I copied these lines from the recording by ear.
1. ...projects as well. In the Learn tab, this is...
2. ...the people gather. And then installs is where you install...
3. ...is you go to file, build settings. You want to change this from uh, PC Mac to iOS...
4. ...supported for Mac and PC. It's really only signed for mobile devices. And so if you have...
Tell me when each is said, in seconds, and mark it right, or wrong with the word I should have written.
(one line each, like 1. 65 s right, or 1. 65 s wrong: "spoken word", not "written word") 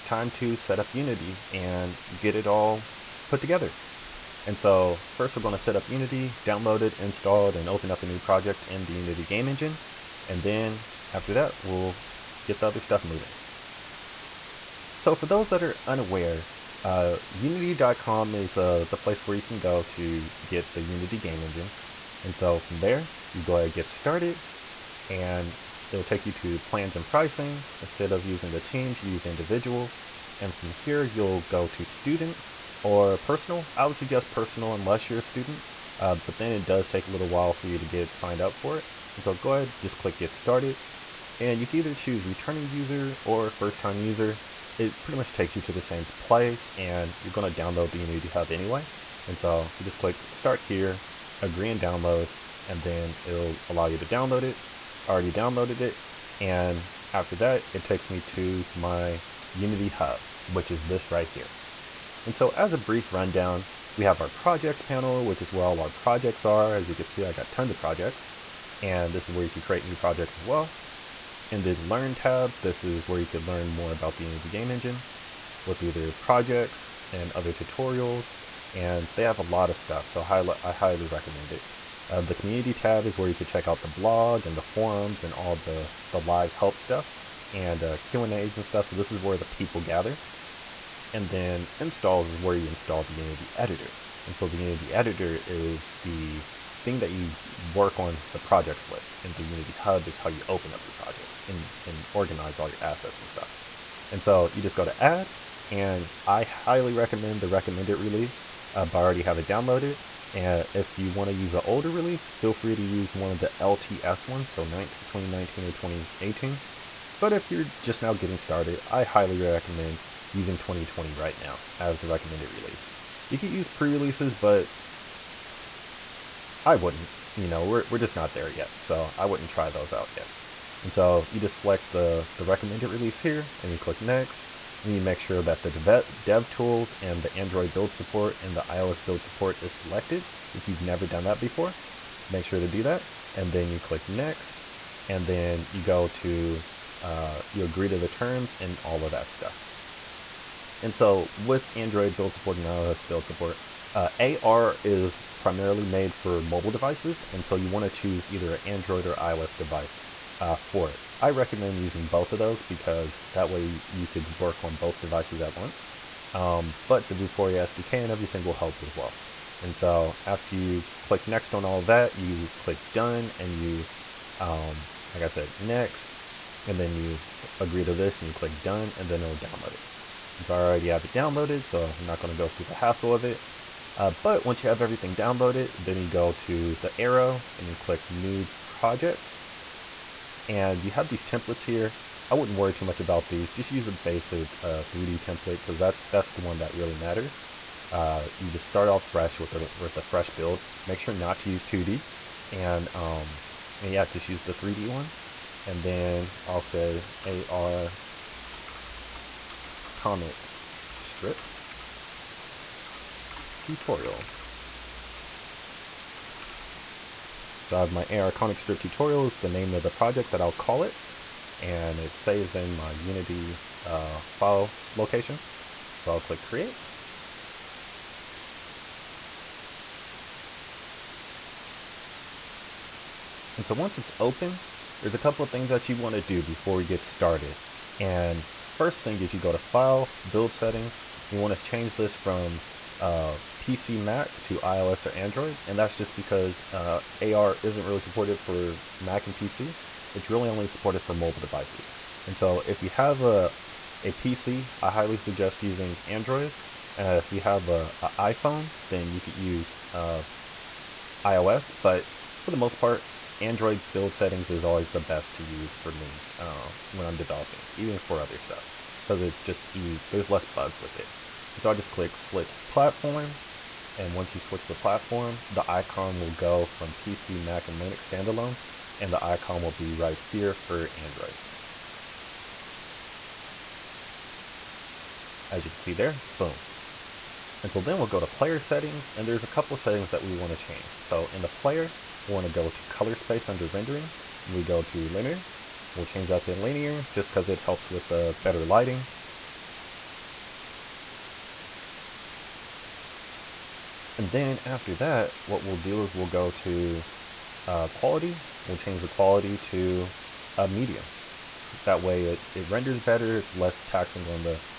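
1. 69 s right
2. 89 s right
3. 239 s right
4. 247 s wrong: "supported", not "signed".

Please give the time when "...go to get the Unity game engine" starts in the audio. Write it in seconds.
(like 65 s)
19 s.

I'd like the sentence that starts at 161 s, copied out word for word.
I recommend using both of those because that way you could work on both devices at once.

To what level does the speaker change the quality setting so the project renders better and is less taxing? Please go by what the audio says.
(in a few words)
Medium.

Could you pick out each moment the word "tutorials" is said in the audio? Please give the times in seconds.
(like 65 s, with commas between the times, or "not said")
77 s, 213 s, 218 s.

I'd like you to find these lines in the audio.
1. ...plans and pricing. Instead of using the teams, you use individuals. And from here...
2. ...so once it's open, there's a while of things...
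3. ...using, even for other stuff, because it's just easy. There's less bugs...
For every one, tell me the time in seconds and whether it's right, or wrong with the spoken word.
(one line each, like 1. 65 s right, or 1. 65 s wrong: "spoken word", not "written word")
1. 26 s right
2. 233 s wrong: "couple", not "while"
3. 267 s wrong: "developing", not "using".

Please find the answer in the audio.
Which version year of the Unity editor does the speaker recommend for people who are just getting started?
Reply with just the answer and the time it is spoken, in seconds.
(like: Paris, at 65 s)
2020, at 120 s.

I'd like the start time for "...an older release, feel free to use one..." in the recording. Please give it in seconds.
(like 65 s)
111 s.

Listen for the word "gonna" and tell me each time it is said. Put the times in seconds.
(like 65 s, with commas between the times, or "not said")
47 s, 182 s.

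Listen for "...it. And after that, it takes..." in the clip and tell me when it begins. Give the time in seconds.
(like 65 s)
55 s.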